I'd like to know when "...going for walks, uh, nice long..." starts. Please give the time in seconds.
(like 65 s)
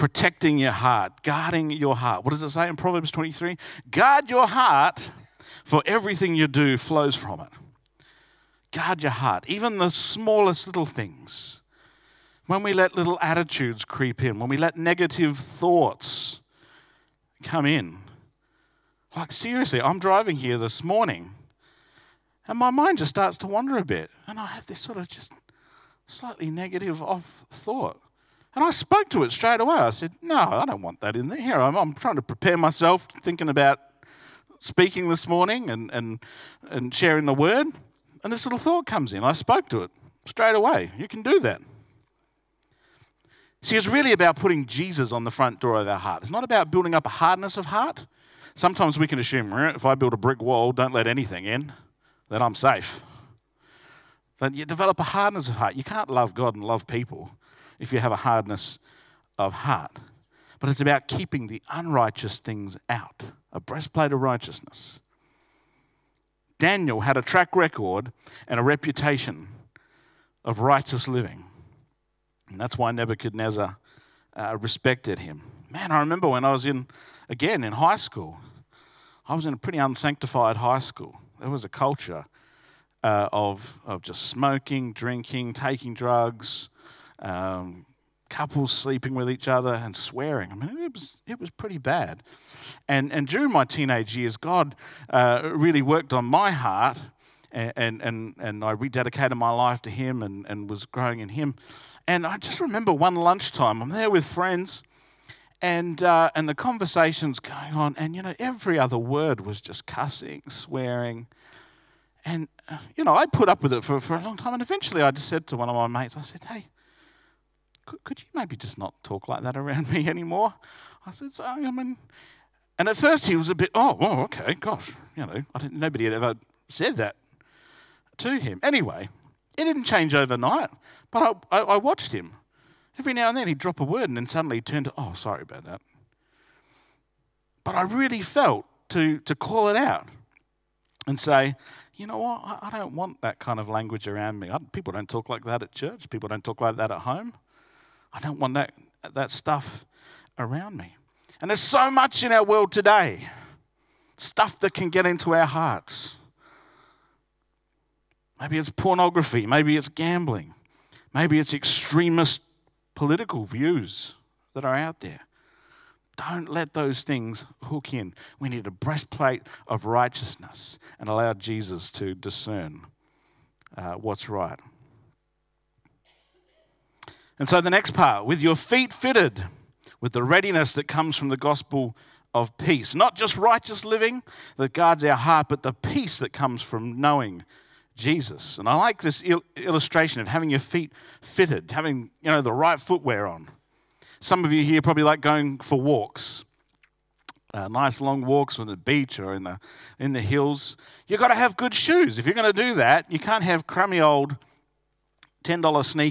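195 s.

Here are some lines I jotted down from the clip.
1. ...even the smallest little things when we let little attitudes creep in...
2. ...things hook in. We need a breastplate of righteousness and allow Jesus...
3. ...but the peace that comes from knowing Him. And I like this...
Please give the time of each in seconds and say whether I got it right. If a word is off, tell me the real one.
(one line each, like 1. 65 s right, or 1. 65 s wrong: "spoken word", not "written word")
1. 9 s right
2. 167 s right
3. 185 s wrong: "Jesus", not "Him".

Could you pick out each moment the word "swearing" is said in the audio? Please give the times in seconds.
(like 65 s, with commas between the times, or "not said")
89 s, 110 s.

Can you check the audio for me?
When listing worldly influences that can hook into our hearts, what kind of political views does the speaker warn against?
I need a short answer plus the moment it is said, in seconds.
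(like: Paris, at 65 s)
Extremist political views, at 161 s.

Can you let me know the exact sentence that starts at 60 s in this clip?
But it's about keeping the unrighteous things out, a breastplate of righteousness.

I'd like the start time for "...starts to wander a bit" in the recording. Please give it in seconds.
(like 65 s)
23 s.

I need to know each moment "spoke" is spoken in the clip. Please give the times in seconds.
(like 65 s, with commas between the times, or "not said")
28 s, 39 s.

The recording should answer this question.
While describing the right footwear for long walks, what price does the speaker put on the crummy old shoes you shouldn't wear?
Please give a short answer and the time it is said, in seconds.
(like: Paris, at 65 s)
$10, at 205 s.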